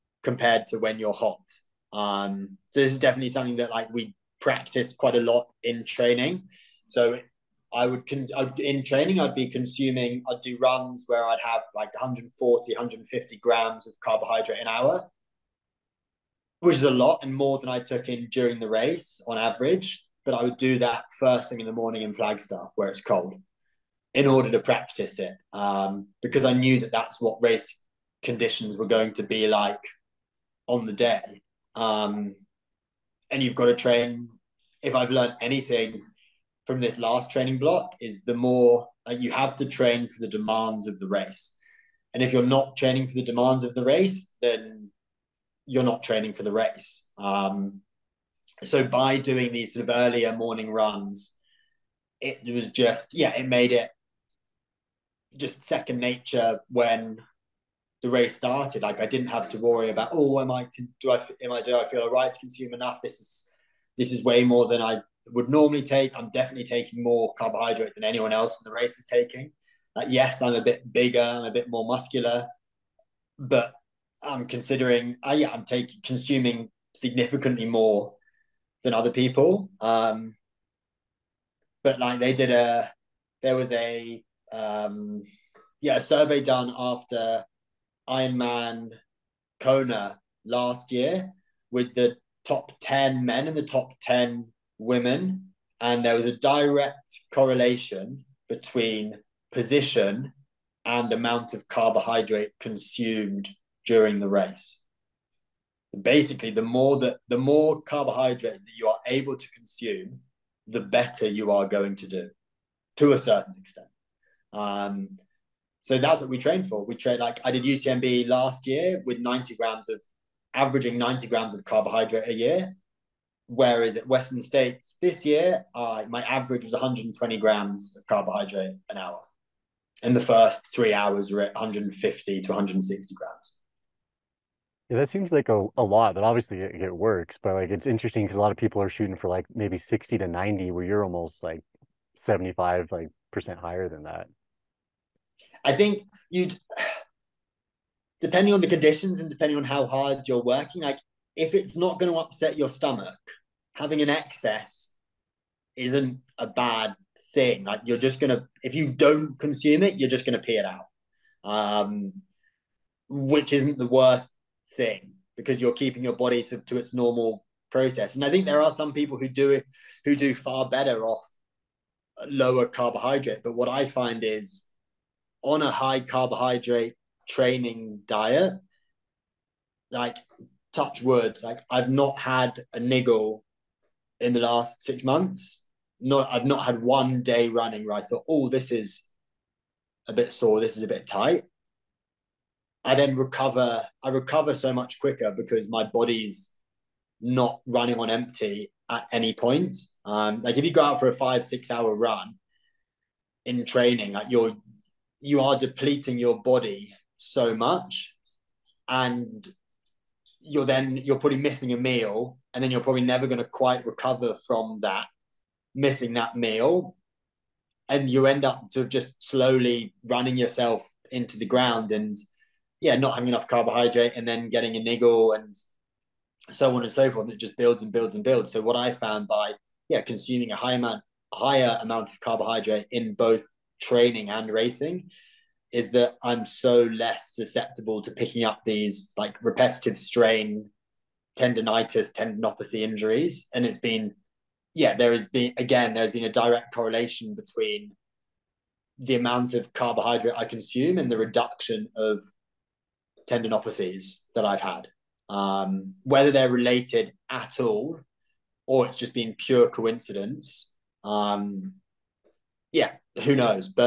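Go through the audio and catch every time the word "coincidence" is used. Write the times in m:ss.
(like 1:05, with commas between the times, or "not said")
4:19.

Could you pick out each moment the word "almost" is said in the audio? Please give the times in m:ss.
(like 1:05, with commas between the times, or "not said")
2:21.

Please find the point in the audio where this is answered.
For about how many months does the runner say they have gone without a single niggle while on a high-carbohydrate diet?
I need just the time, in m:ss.
3:04.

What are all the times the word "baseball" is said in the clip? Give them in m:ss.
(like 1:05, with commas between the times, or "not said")
not said.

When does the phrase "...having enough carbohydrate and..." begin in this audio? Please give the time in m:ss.
3:43.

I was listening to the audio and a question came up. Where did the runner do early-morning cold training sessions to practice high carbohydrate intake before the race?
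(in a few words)
Flagstaff.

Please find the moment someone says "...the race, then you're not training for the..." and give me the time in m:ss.
0:43.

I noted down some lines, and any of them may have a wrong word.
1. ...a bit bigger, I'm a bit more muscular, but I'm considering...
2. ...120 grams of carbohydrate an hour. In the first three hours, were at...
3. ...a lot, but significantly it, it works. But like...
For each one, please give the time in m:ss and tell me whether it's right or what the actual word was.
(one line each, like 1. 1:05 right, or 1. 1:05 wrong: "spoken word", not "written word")
1. 1:10 right
2. 2:06 right
3. 2:15 wrong: "obviously", not "significantly".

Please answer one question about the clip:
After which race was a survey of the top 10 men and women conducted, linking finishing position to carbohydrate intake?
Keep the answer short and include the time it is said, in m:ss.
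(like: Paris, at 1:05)
Ironman Kona, at 1:28.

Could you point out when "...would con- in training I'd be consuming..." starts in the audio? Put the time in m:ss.
0:07.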